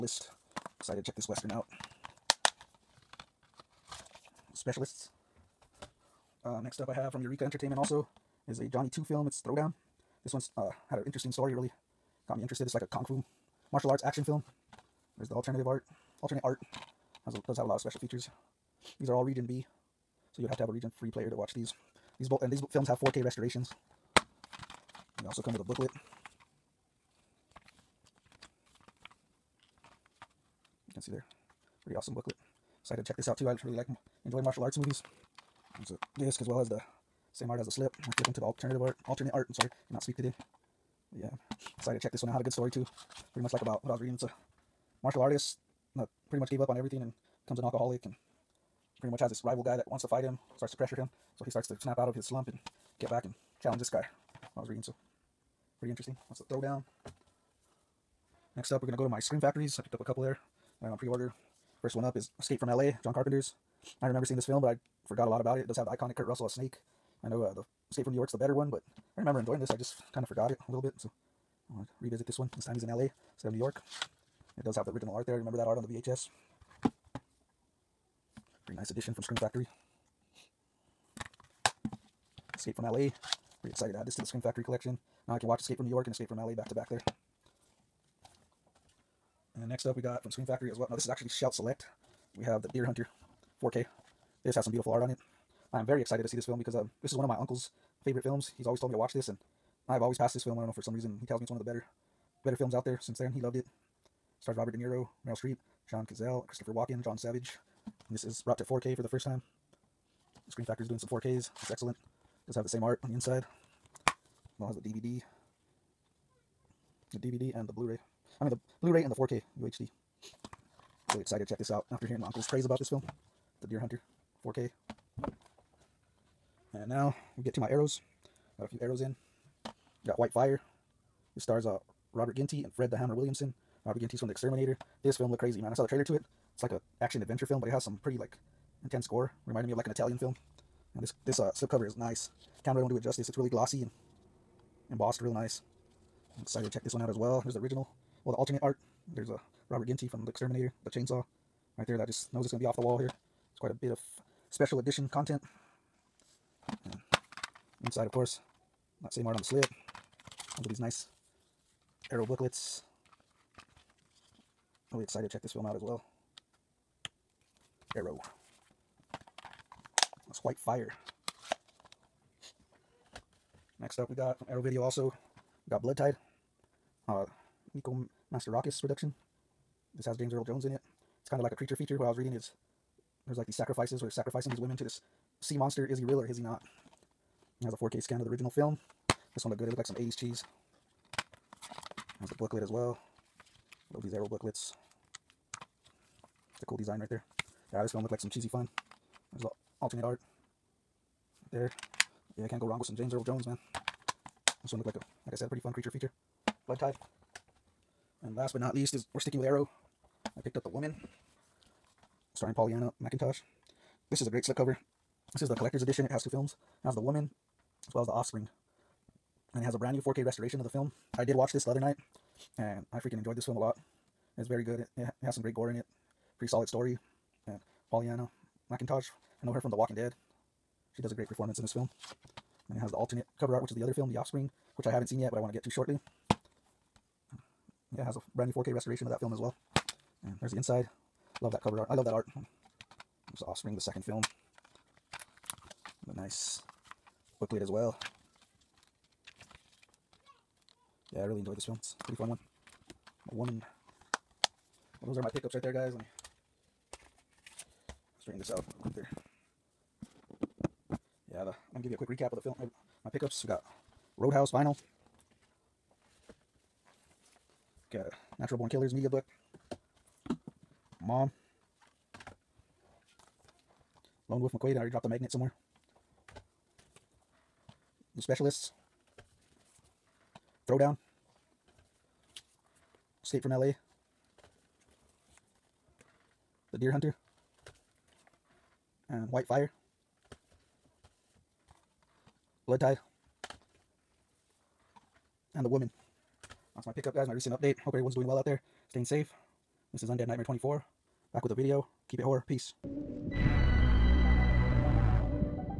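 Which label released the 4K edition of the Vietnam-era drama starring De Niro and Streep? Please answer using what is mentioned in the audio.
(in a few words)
Shout Select.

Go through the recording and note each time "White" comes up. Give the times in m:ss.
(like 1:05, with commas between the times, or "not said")
2:10, 2:50, 4:49.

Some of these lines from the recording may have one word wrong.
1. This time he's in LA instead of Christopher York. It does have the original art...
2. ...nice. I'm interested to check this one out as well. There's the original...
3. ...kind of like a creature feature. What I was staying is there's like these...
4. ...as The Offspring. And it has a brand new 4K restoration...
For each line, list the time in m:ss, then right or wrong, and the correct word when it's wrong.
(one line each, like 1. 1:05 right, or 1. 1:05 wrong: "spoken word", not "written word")
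1. 1:12 wrong: "New", not "Christopher"
2. 2:25 wrong: "excited", not "interested"
3. 3:01 wrong: "reading", not "staying"
4. 3:38 right.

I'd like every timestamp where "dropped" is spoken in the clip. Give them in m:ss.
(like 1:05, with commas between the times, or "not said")
4:34.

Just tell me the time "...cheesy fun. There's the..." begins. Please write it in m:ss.
3:18.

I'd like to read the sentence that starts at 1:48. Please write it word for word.
And this is brought to 4K for the first time.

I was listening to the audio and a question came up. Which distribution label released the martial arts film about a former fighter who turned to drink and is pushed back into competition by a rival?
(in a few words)
Eureka Entertainment.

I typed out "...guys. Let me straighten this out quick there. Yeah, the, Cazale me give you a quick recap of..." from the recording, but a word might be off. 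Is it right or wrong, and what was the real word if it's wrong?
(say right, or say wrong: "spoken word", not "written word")
wrong: "Let", not "Cazale".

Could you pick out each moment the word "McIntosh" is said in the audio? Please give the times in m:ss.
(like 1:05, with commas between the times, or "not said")
3:33, 3:48.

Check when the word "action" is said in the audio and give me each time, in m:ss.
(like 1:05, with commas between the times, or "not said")
0:14, 2:17.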